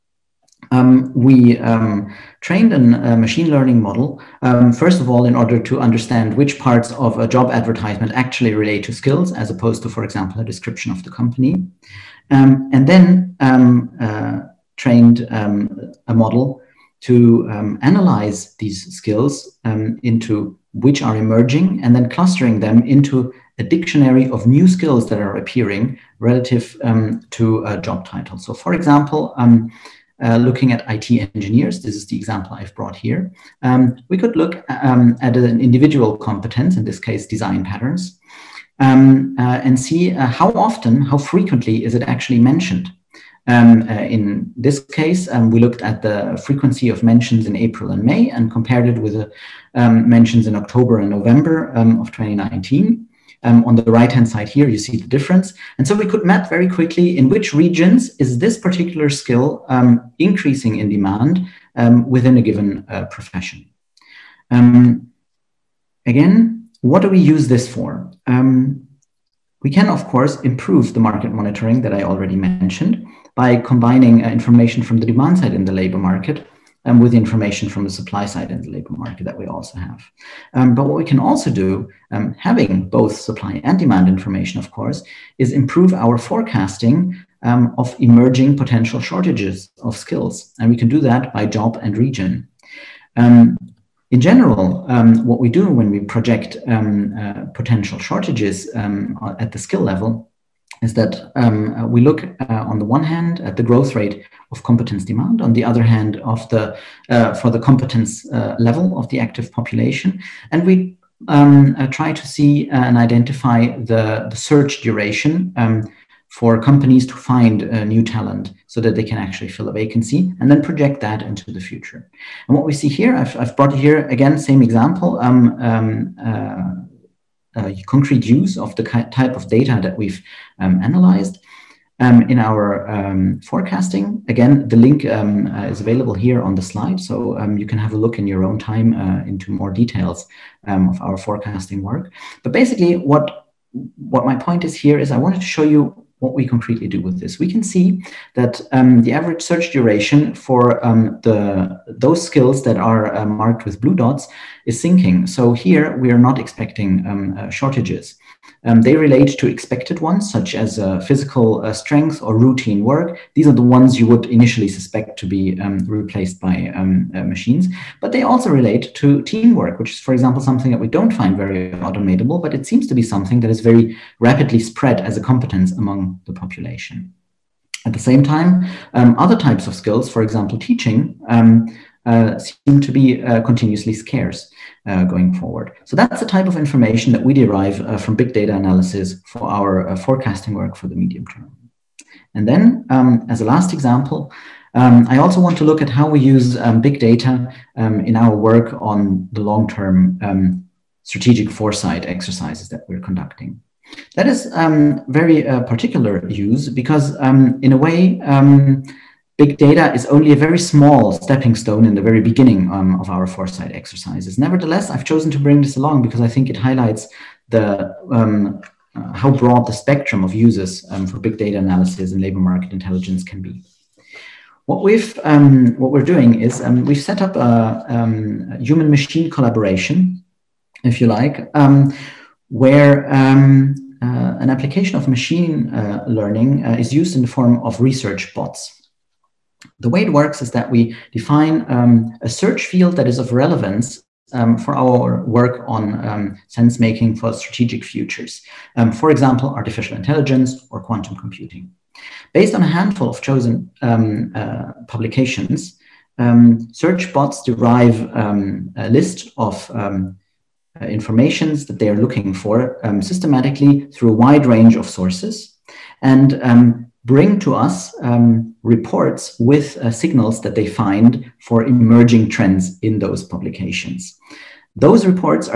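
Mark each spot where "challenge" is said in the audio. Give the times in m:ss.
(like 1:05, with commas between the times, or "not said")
not said.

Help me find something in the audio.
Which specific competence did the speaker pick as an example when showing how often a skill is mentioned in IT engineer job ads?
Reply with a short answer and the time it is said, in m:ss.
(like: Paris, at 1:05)
Design patterns, at 0:37.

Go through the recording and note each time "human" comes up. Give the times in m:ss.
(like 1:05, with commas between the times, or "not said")
3:48.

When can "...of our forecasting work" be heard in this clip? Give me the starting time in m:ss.
2:20.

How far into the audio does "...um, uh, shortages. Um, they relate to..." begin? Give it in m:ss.
2:37.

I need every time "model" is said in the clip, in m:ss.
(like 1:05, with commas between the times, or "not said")
0:03, 0:16.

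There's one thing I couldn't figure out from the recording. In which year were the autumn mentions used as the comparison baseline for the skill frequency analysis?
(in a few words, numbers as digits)
2019.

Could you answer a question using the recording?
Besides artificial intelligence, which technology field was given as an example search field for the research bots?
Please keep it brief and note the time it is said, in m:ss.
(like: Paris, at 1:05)
Quantum computing, at 4:10.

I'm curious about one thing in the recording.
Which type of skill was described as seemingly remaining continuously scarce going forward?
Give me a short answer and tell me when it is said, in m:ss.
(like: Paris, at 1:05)
Teaching, at 3:00.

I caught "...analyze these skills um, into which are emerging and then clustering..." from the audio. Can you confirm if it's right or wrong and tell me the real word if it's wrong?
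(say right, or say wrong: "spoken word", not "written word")
right.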